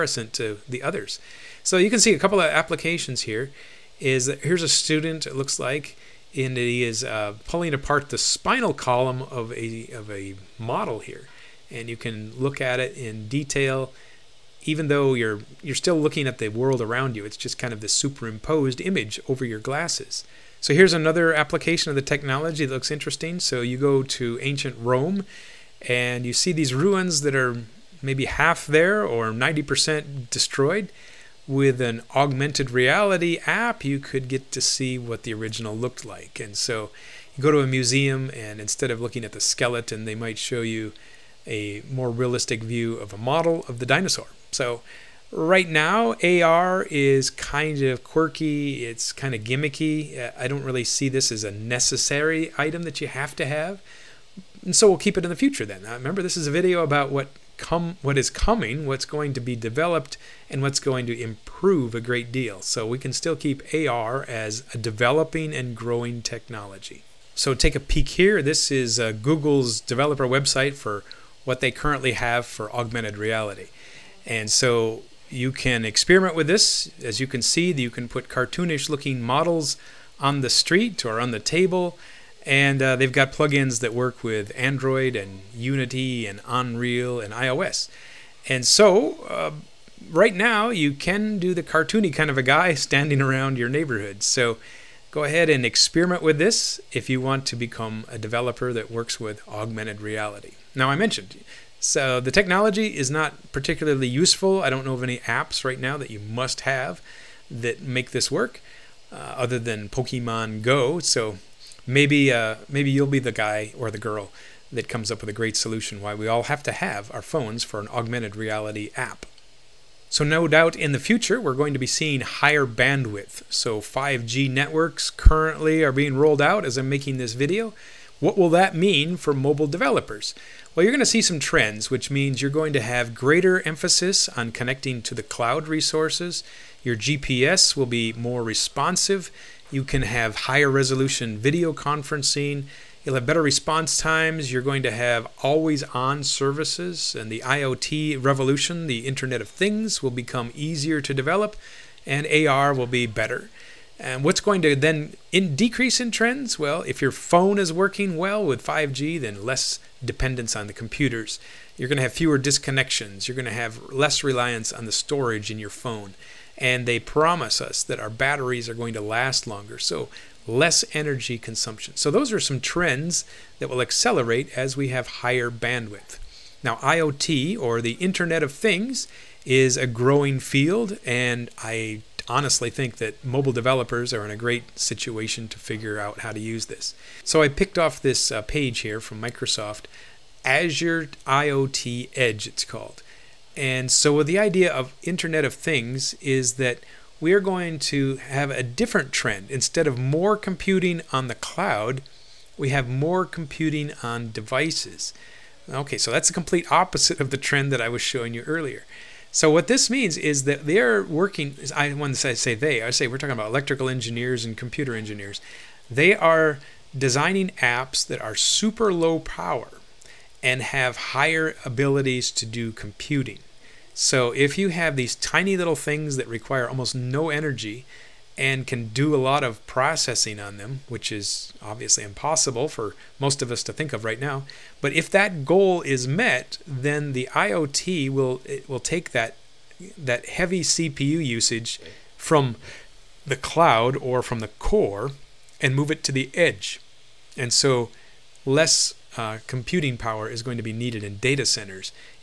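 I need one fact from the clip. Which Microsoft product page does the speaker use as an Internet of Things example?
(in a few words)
Azure IoT Edge.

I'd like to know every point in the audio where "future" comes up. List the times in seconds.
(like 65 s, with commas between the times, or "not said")
55 s, 120 s.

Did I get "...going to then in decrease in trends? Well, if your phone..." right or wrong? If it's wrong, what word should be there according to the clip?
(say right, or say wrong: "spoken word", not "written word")
right.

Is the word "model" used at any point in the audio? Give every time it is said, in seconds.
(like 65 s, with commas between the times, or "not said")
10 s, 43 s, 79 s.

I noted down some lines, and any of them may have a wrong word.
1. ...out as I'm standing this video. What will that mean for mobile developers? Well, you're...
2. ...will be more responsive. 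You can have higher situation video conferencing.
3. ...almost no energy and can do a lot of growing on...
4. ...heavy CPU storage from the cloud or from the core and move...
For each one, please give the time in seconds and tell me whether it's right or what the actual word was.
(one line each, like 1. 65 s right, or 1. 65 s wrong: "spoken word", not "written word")
1. 126 s wrong: "making", not "standing"
2. 137 s wrong: "resolution", not "situation"
3. 226 s wrong: "processing", not "growing"
4. 240 s wrong: "usage", not "storage".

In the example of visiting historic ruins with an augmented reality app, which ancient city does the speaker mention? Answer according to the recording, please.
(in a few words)
Rome.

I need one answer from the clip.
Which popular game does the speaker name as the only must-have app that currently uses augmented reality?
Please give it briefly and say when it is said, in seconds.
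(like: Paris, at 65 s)
Pokemon Go, at 109 s.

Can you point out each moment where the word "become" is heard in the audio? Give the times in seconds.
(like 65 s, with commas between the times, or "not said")
97 s, 150 s.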